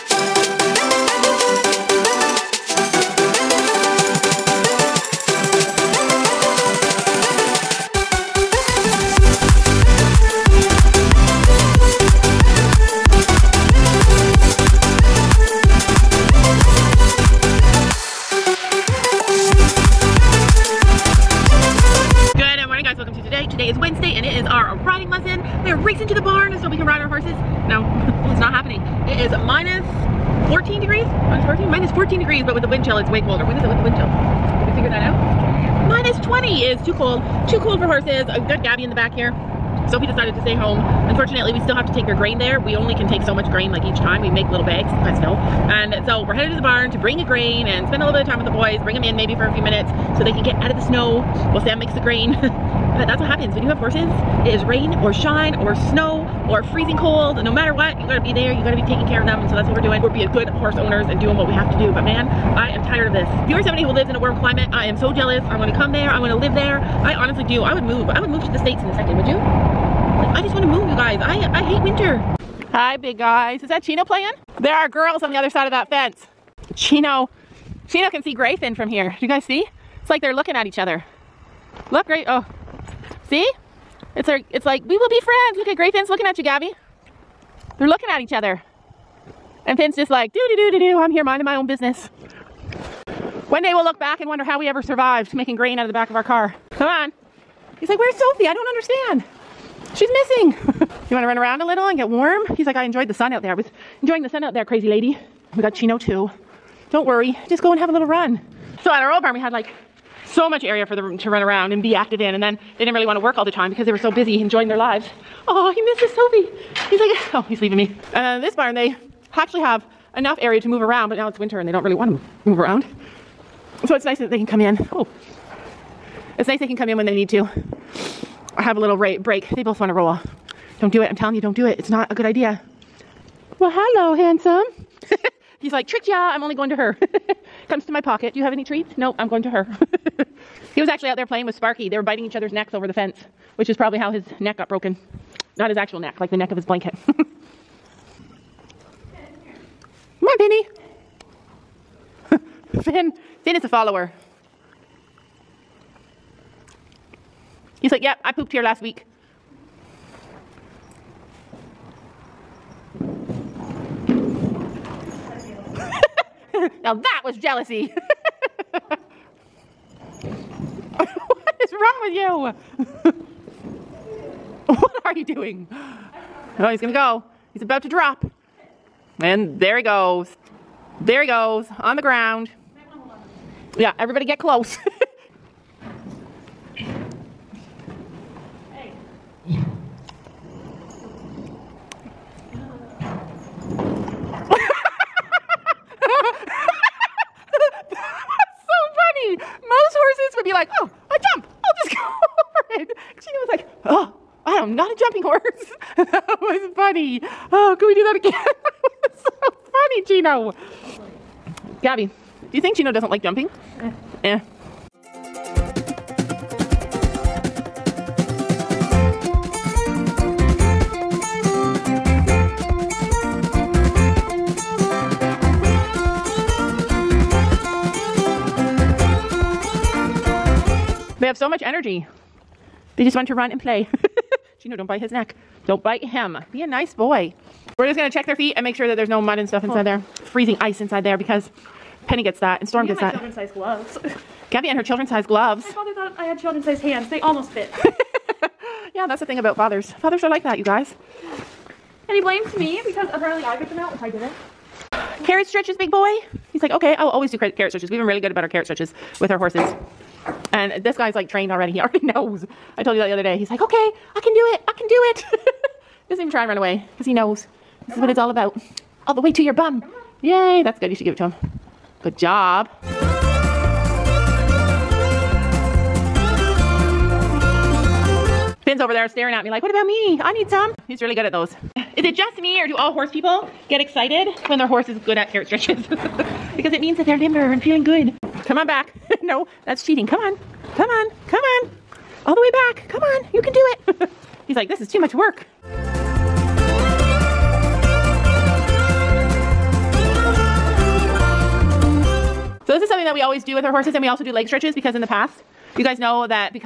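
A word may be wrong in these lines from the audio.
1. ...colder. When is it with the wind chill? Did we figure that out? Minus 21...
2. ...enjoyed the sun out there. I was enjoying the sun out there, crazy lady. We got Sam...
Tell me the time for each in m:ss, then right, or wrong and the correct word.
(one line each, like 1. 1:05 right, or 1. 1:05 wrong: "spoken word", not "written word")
1. 0:33 wrong: "20", not "21"
2. 1:42 wrong: "Chino", not "Sam".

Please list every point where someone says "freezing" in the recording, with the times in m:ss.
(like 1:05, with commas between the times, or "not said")
0:56, 4:00.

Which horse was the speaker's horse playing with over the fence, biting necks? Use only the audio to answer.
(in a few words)
Sparky.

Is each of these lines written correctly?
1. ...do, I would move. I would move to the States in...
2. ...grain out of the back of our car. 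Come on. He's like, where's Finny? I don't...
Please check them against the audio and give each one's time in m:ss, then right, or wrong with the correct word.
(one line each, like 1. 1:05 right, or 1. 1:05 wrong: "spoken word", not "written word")
1. 1:07 right
2. 1:35 wrong: "Sophie", not "Finny".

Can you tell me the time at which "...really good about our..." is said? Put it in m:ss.
4:18.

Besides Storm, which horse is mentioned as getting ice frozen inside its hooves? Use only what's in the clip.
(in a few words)
Penny.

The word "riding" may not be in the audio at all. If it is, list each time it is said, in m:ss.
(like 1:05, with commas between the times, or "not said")
0:24.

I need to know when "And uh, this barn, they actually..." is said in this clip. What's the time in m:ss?
1:58.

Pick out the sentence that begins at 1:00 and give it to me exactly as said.
We're being good horse owners and doing what we have to do, but man, I am tired of this.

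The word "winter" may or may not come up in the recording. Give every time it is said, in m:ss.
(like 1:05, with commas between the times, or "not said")
1:11, 2:01.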